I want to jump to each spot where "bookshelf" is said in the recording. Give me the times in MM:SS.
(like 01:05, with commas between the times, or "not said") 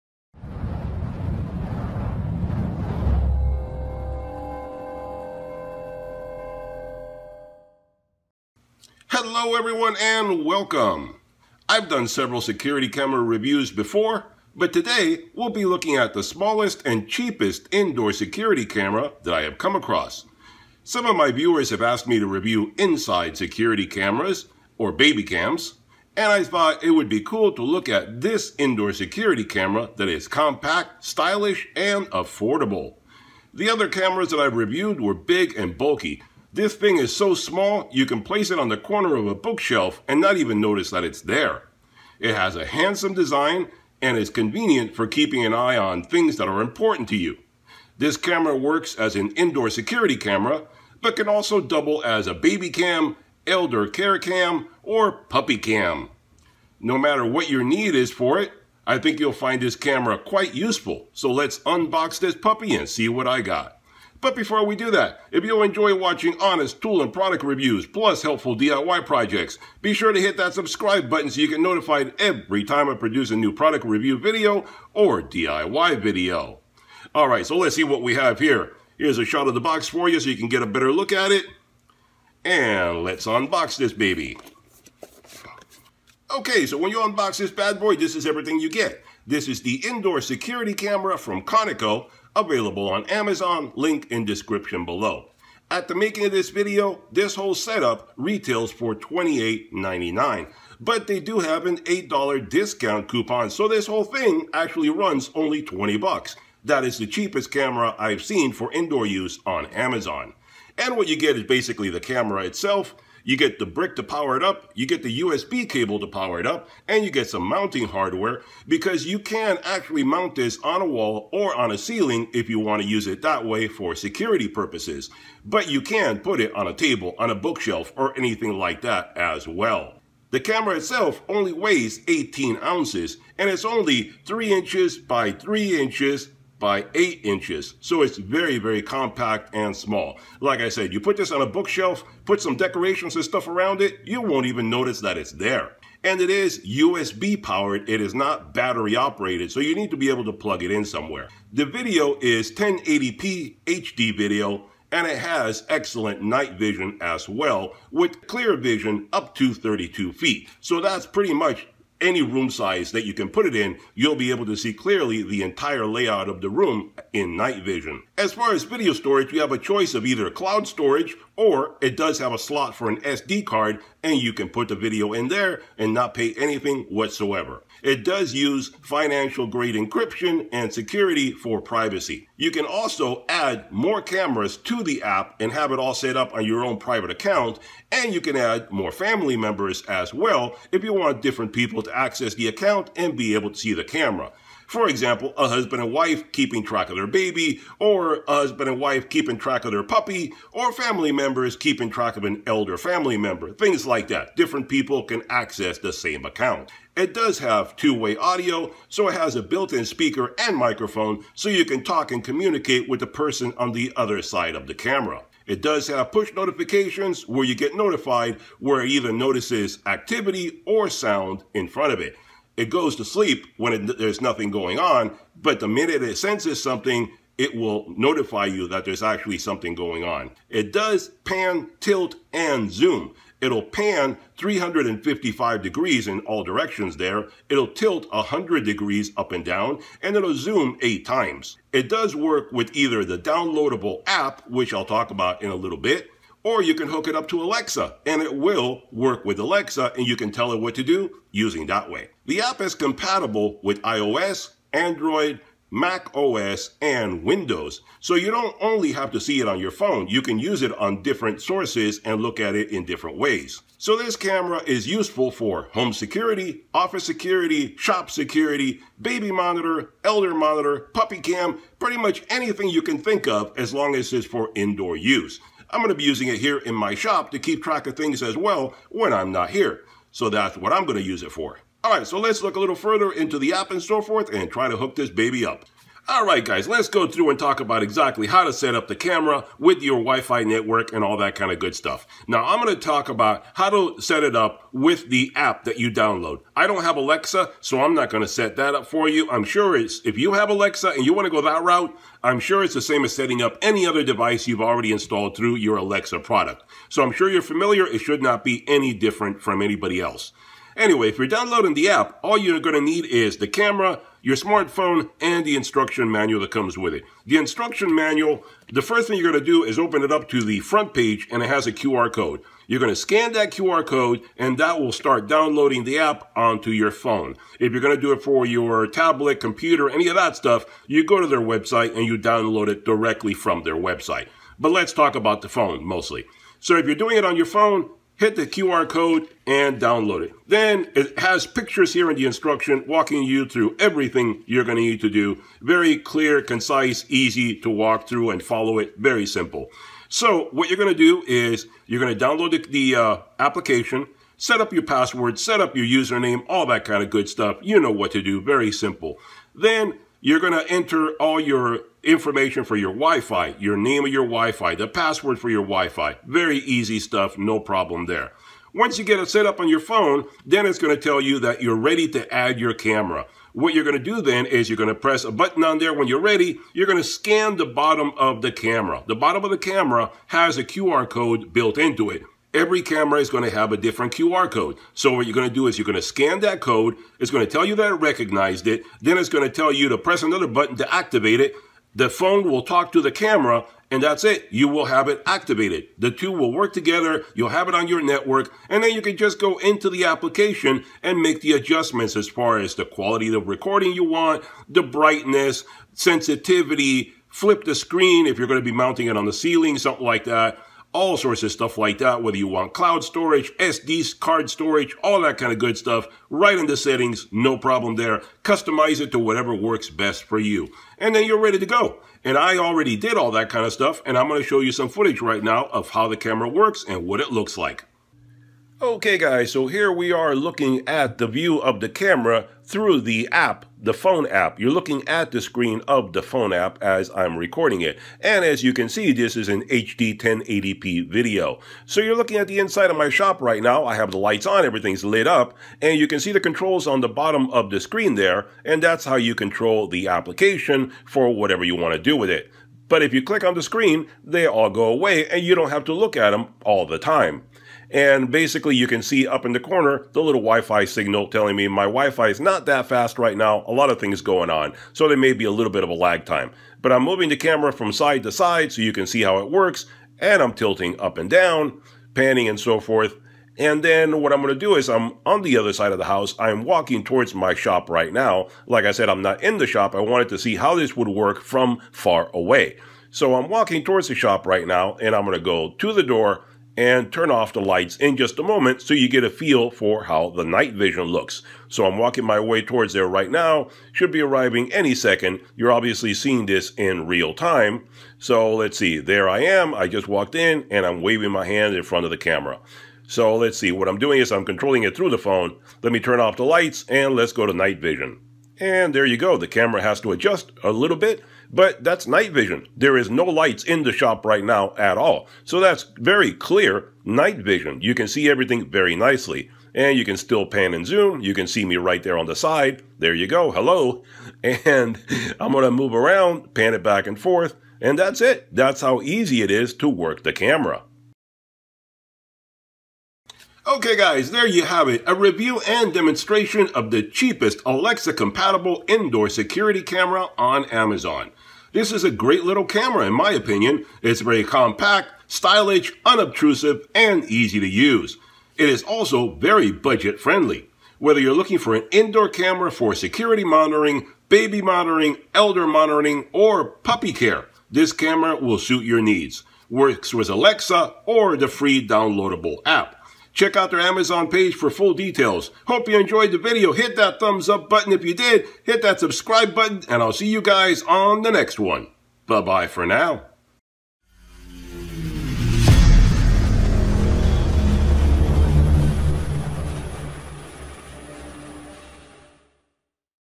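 00:39, 02:07, 02:21.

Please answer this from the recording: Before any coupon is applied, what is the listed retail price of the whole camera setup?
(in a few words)
$28.99.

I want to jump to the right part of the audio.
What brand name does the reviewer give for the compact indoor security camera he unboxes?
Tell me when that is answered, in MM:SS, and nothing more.
01:31.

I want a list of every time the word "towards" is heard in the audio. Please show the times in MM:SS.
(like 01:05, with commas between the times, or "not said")
07:57, 08:03, 08:12.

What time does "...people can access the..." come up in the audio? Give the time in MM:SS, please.
03:24.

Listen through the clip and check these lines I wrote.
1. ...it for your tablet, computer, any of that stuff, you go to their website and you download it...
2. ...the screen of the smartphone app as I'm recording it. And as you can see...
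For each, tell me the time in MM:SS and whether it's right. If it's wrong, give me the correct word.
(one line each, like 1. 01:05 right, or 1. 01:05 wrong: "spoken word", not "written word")
1. 05:28 right
2. 07:15 wrong: "phone", not "smartphone".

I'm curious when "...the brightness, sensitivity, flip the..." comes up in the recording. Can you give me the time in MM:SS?
06:44.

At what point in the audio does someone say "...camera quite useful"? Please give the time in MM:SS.
00:59.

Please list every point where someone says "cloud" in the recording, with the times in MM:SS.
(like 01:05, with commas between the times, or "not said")
02:50, 06:52.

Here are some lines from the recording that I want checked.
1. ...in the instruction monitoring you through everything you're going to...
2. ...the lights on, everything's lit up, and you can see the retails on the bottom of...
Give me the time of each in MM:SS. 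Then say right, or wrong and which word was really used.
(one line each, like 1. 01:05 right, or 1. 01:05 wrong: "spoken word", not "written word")
1. 05:42 wrong: "walking", not "monitoring"
2. 07:24 wrong: "controls", not "retails".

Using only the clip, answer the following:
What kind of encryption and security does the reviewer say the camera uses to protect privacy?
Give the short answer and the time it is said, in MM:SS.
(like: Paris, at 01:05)
financial grade, at 02:58.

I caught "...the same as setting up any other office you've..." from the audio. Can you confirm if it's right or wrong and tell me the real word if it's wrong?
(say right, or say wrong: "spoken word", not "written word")
wrong: "device", not "office".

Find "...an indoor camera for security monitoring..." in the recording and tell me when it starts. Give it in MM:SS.
09:11.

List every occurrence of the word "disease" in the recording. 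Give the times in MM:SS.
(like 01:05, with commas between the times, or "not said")
not said.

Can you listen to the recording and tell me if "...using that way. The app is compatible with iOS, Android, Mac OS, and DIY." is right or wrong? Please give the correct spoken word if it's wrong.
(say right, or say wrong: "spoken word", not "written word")
wrong: "Windows", not "DIY".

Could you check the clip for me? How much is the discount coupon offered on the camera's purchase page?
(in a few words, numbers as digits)
$8.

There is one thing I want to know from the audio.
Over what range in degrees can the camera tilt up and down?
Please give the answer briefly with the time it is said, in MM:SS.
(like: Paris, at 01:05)
100 degrees, at 03:58.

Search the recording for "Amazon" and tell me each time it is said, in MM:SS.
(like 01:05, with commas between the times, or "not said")
01:33, 01:49, 09:00, 09:23.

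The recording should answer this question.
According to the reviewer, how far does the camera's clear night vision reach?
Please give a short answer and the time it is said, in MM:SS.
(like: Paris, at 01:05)
32 feet, at 02:39.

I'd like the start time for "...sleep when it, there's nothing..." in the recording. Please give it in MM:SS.
03:43.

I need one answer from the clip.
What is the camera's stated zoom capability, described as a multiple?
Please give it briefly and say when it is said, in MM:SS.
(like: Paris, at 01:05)
8 times, at 04:00.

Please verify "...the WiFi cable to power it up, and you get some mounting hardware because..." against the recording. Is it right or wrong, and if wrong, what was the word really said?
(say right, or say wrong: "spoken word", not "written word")
wrong: "USB", not "WiFi".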